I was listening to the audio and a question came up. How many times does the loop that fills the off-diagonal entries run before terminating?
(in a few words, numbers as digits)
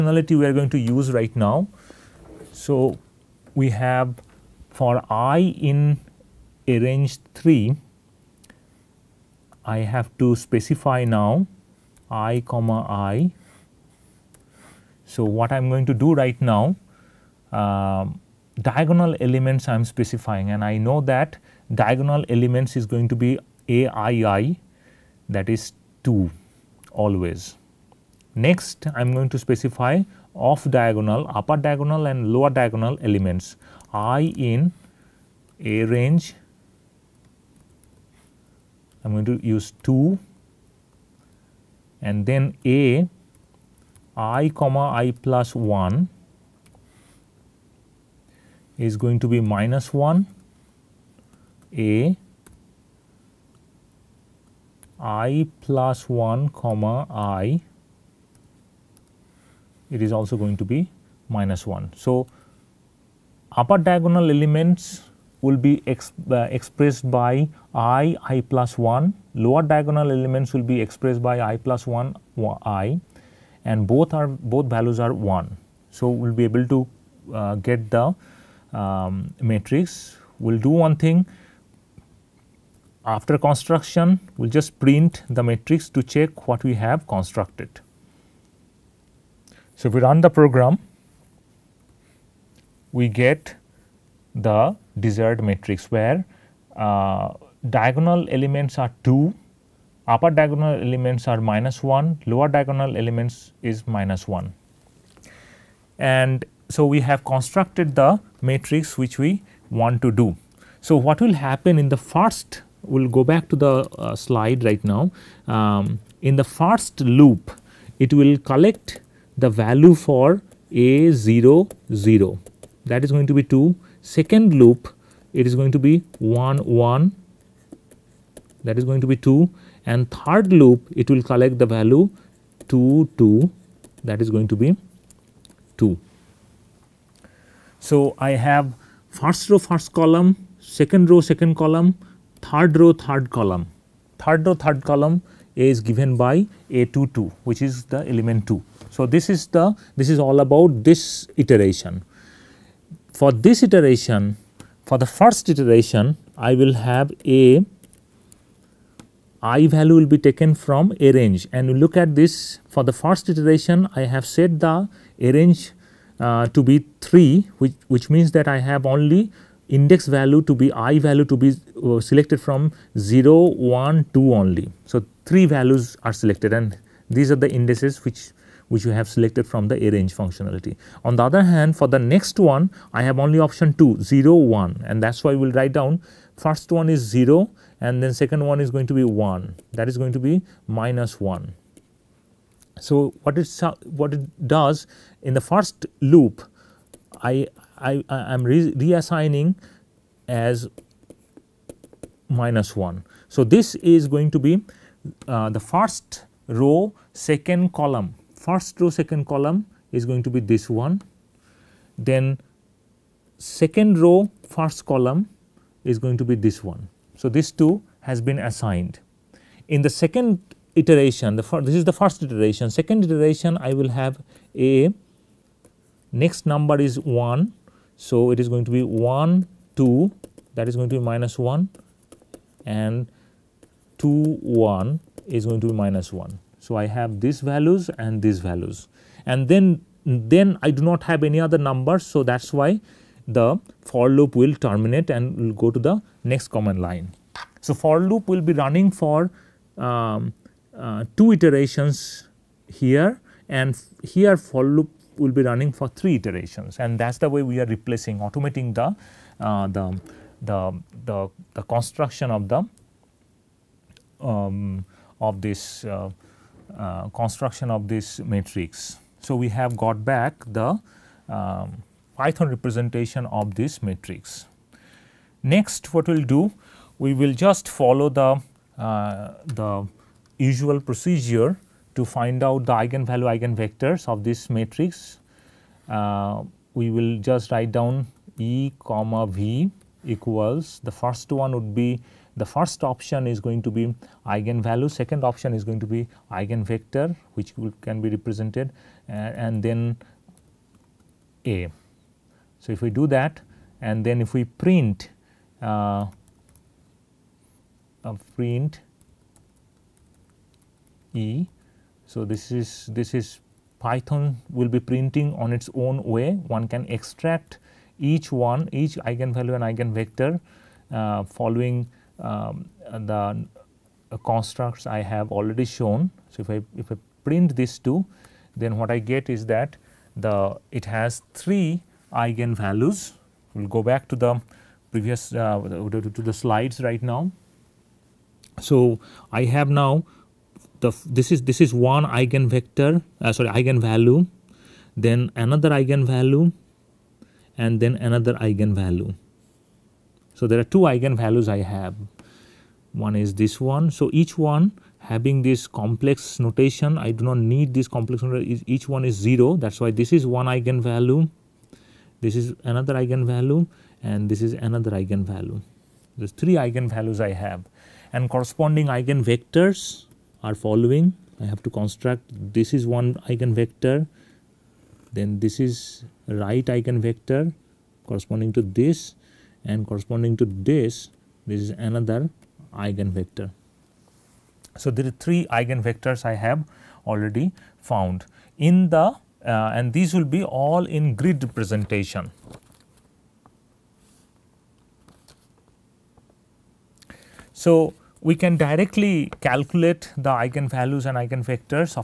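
2.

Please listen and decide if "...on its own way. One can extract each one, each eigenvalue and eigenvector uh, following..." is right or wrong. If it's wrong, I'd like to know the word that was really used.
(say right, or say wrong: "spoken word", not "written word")
right.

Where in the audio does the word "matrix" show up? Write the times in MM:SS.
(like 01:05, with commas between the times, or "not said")
01:19, 01:25, 01:35, 01:48, 04:28, 04:33, 04:44.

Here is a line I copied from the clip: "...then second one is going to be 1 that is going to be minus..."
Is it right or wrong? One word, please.
right.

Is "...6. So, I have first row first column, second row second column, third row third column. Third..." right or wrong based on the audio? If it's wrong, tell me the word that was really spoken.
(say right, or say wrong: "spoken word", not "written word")
wrong: "2", not "6".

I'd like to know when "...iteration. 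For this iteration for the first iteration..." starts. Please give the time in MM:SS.
02:31.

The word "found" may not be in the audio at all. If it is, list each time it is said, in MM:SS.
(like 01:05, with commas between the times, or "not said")
06:27.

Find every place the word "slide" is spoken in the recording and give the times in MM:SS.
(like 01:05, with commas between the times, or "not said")
01:54, 05:36.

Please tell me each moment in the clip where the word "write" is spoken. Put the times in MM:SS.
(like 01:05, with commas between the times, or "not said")
03:05, 04:47.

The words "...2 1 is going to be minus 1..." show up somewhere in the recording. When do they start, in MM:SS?
03:53.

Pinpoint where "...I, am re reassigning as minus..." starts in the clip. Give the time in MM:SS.
03:17.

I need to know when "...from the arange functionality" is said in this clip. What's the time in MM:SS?
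02:59.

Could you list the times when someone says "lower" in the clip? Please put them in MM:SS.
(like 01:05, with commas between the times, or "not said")
00:32, 01:09, 01:42.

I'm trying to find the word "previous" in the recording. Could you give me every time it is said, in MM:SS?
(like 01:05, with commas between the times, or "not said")
05:34.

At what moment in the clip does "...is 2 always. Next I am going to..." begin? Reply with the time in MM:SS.
00:25.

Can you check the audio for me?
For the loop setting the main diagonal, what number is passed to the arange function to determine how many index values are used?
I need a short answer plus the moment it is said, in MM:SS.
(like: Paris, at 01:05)
3, at 02:46.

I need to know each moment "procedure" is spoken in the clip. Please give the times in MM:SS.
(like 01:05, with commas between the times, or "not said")
04:40.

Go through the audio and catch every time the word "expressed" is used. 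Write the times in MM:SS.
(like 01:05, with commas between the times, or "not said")
01:06, 01:10.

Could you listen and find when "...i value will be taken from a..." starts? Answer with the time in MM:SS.
02:39.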